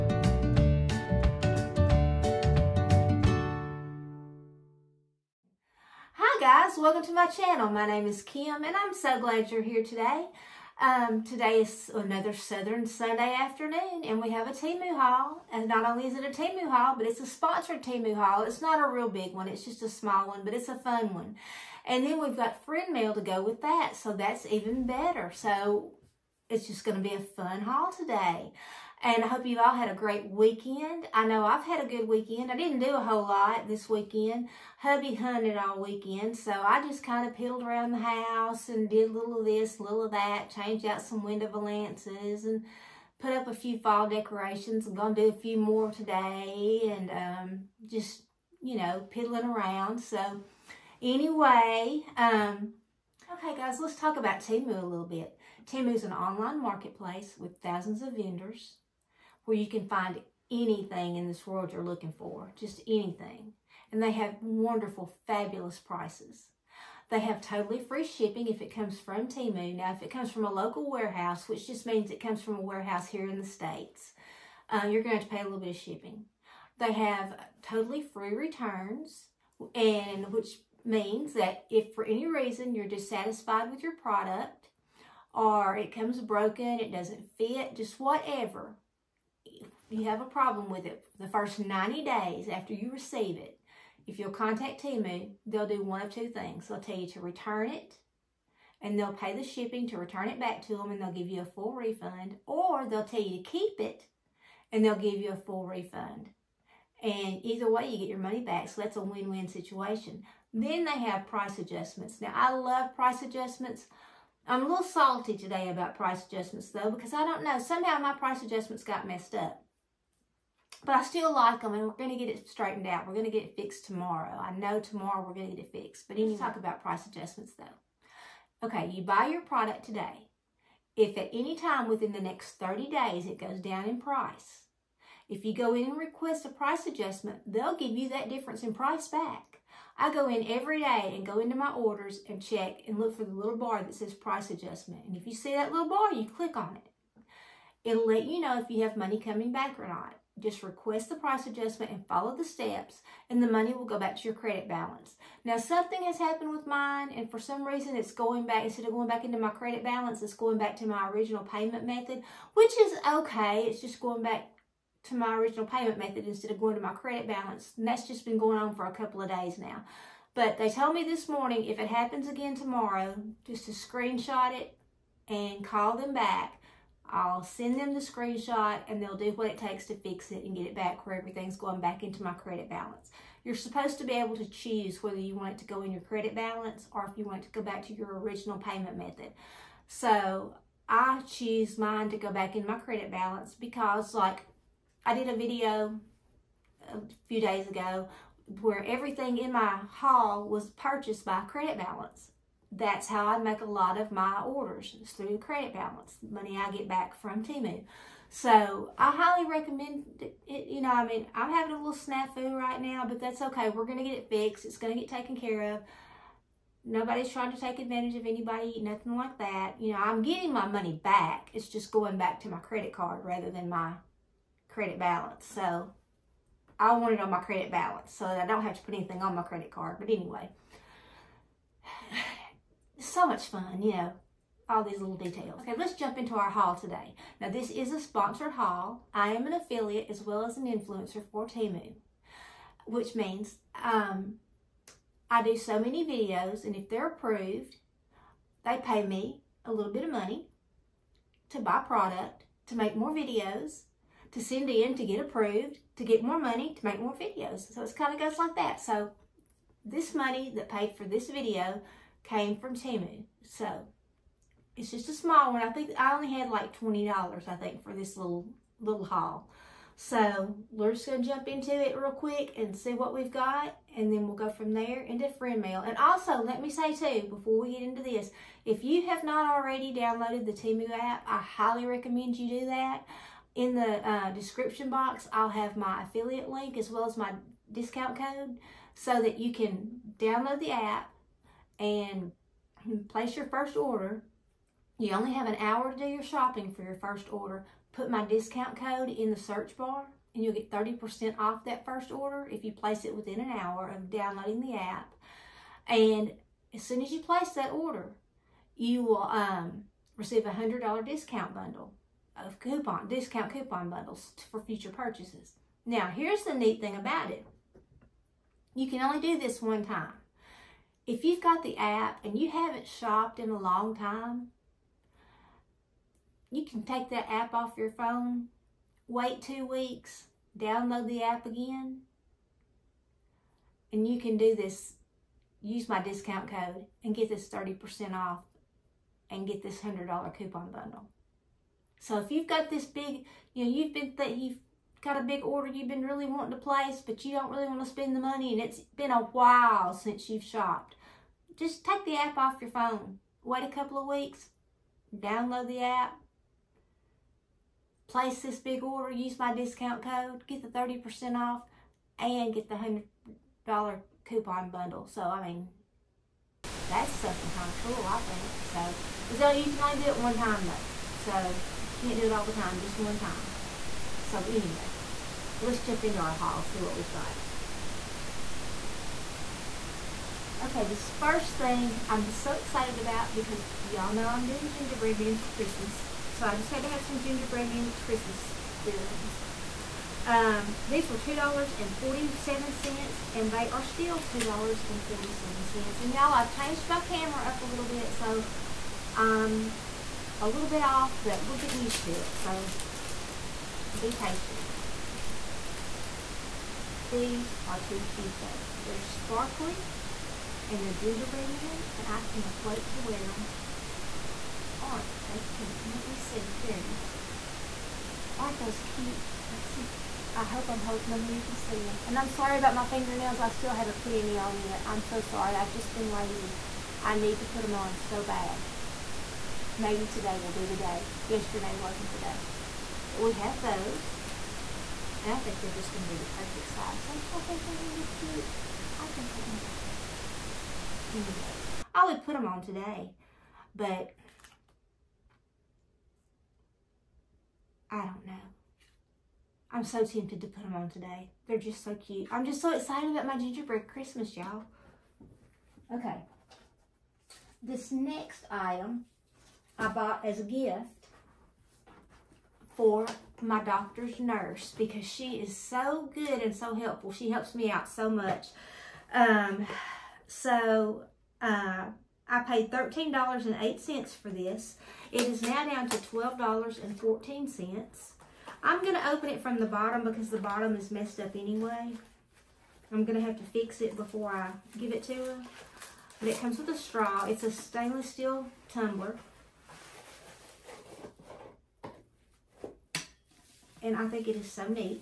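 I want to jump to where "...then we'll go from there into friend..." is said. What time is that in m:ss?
4:34.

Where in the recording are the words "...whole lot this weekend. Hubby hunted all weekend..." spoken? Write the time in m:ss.
0:32.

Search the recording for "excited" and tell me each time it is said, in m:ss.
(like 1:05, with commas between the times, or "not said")
6:22, 7:32.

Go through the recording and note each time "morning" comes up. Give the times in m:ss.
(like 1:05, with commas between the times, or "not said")
2:51.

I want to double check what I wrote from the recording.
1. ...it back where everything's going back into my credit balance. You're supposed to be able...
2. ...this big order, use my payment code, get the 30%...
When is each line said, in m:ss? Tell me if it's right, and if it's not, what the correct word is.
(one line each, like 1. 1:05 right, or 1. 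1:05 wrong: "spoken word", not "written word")
1. 3:00 right
2. 5:58 wrong: "discount", not "payment".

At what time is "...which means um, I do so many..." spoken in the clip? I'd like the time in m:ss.
4:02.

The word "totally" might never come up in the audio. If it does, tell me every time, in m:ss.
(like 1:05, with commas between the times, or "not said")
1:07, 1:17.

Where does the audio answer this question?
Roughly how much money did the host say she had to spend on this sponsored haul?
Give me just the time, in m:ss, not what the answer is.
4:26.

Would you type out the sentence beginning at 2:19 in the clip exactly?
I go in every day and go into my orders and check and look for the little bar that says price adjustment.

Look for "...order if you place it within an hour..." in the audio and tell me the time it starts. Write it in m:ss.
5:02.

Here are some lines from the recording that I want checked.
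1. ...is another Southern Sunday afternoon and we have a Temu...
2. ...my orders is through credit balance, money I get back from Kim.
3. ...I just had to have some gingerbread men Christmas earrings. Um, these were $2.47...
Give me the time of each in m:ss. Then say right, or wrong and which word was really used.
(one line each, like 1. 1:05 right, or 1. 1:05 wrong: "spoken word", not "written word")
1. 0:11 right
2. 3:24 wrong: "Temu", not "Kim"
3. 6:26 right.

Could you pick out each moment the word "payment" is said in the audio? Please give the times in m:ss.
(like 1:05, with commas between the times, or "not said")
2:41, 2:45, 3:08.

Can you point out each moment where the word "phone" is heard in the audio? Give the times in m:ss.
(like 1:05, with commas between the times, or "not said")
5:27, 5:52.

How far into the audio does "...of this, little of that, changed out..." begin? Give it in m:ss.
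0:39.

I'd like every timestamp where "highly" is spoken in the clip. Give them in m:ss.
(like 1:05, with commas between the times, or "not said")
3:29, 4:41.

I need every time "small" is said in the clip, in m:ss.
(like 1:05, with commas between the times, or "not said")
0:19, 4:25.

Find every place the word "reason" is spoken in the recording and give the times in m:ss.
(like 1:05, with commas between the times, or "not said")
1:22, 2:37.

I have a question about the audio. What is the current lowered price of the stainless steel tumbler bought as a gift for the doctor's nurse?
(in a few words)
$12.14.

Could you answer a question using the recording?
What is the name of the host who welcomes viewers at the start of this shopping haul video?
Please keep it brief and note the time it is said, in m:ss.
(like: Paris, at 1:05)
Kim, at 0:08.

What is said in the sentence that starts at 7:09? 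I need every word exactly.
Maybe today will be the day.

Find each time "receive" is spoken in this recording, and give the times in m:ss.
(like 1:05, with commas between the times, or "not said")
1:32, 5:10.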